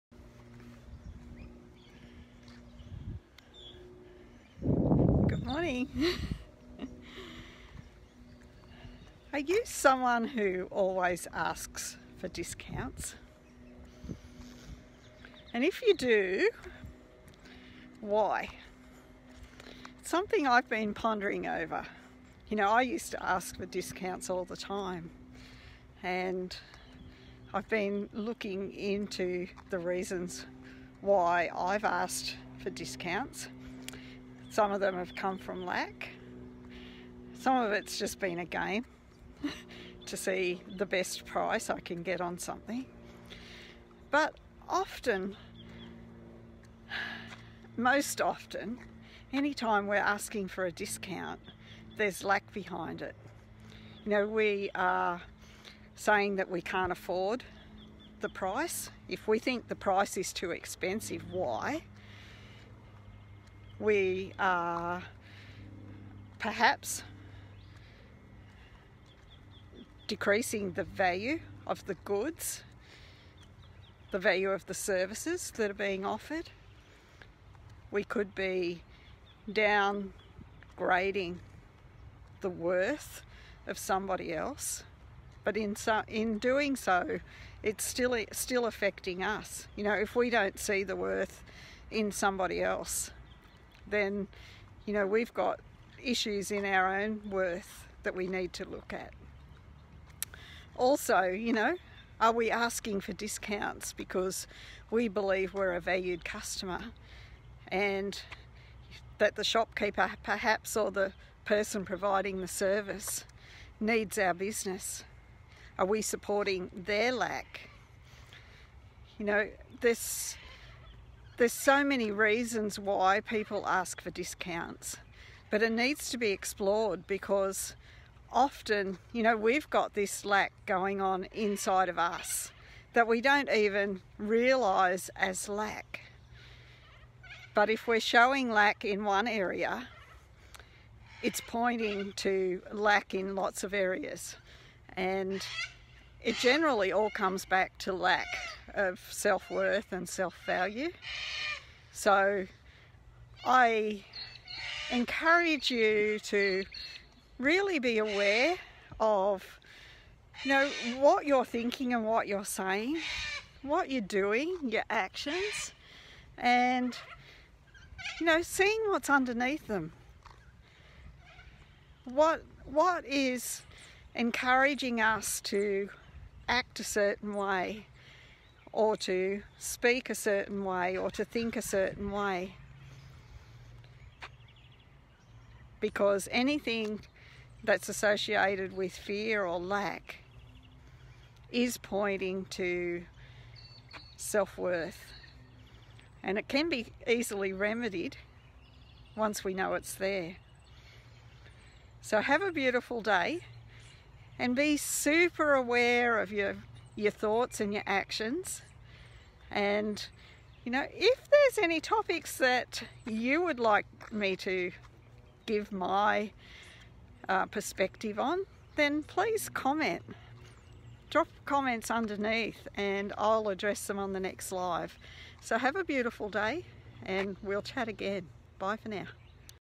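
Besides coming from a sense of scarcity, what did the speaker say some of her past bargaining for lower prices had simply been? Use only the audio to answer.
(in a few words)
A game.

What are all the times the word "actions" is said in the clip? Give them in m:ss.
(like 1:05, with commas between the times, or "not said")
2:44, 3:27.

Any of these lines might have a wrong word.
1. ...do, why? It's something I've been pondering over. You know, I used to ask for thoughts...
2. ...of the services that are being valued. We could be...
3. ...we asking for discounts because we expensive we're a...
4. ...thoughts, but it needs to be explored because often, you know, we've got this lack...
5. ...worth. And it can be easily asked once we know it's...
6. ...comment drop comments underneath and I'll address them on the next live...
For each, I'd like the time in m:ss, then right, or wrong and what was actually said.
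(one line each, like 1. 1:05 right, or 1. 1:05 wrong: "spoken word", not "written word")
1. 0:15 wrong: "discounts", not "thoughts"
2. 1:14 wrong: "offered", not "valued"
3. 1:42 wrong: "believe", not "expensive"
4. 2:04 wrong: "discounts", not "thoughts"
5. 3:14 wrong: "remedied", not "asked"
6. 3:39 right.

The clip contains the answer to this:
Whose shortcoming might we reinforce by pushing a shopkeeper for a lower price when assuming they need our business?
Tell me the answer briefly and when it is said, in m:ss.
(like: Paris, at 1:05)
Their lack, at 1:56.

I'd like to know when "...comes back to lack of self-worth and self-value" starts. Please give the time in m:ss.
2:27.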